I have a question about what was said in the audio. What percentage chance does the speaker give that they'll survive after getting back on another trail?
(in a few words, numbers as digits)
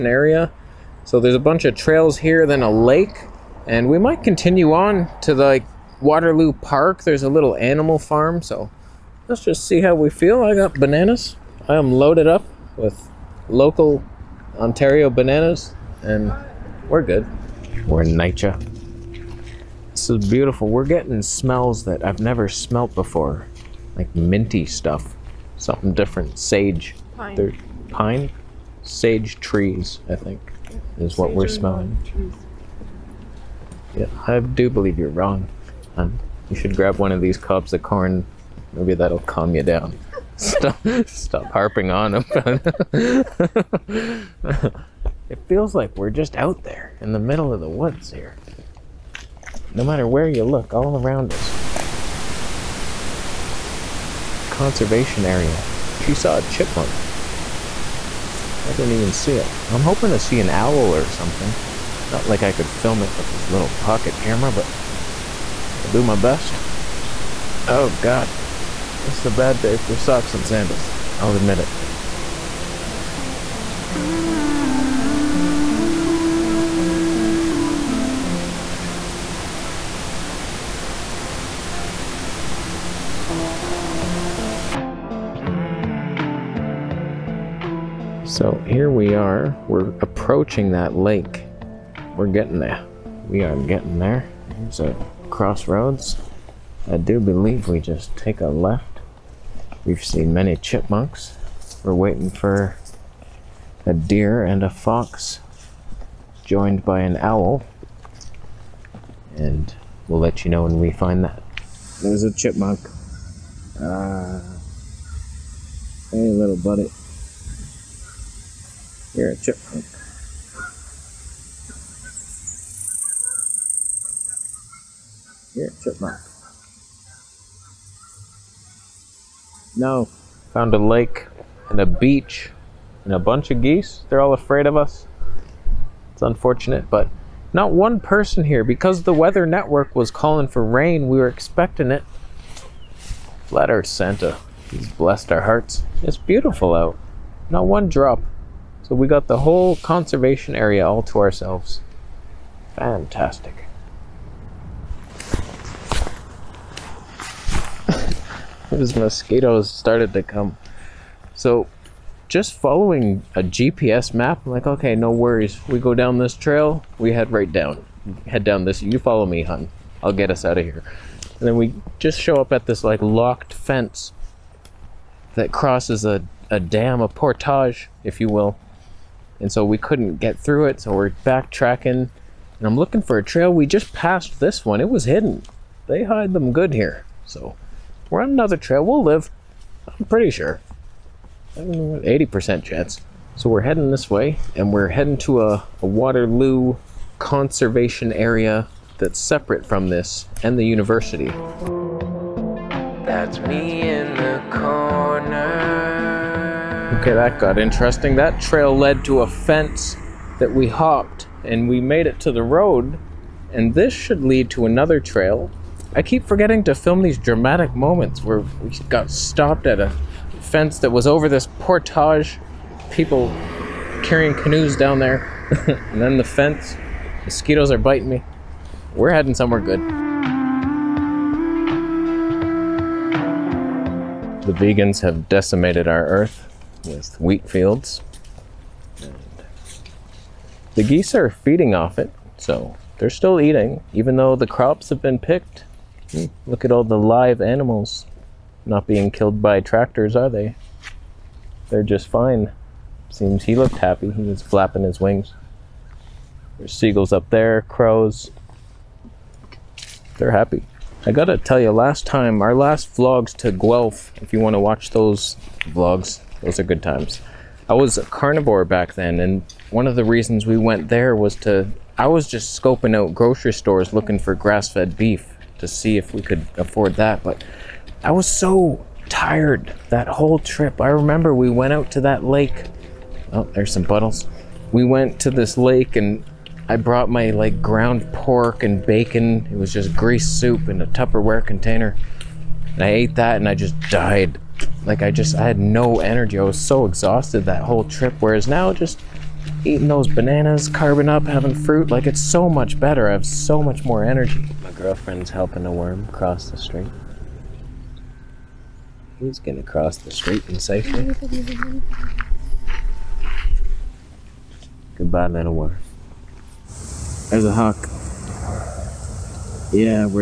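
80%.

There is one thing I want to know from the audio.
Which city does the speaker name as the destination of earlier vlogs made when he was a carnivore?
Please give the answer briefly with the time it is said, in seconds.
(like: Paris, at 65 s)
Guelph, at 263 s.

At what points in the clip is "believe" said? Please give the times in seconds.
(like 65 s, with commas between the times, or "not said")
34 s, 97 s.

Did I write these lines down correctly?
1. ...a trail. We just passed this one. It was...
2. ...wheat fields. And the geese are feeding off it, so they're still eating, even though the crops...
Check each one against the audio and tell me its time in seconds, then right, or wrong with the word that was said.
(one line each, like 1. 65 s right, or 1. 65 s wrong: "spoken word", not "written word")
1. 183 s right
2. 237 s right.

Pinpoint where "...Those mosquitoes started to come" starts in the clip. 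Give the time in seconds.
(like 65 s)
158 s.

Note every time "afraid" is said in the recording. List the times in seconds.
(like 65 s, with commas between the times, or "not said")
134 s.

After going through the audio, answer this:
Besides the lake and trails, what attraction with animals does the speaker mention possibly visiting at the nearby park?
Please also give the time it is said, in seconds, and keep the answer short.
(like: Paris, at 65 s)
A little animal farm, at 7 s.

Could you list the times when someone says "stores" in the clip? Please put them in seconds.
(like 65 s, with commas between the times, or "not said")
273 s.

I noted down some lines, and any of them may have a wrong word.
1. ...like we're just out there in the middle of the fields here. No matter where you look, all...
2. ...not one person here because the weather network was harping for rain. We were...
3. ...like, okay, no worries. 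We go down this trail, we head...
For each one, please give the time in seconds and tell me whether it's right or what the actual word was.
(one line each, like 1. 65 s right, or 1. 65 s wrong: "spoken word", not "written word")
1. 45 s wrong: "woods", not "fields"
2. 137 s wrong: "calling", not "harping"
3. 164 s right.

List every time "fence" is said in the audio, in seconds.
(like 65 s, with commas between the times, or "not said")
173 s, 209 s, 220 s, 226 s.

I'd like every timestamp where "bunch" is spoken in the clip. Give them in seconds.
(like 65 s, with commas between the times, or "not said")
1 s, 133 s.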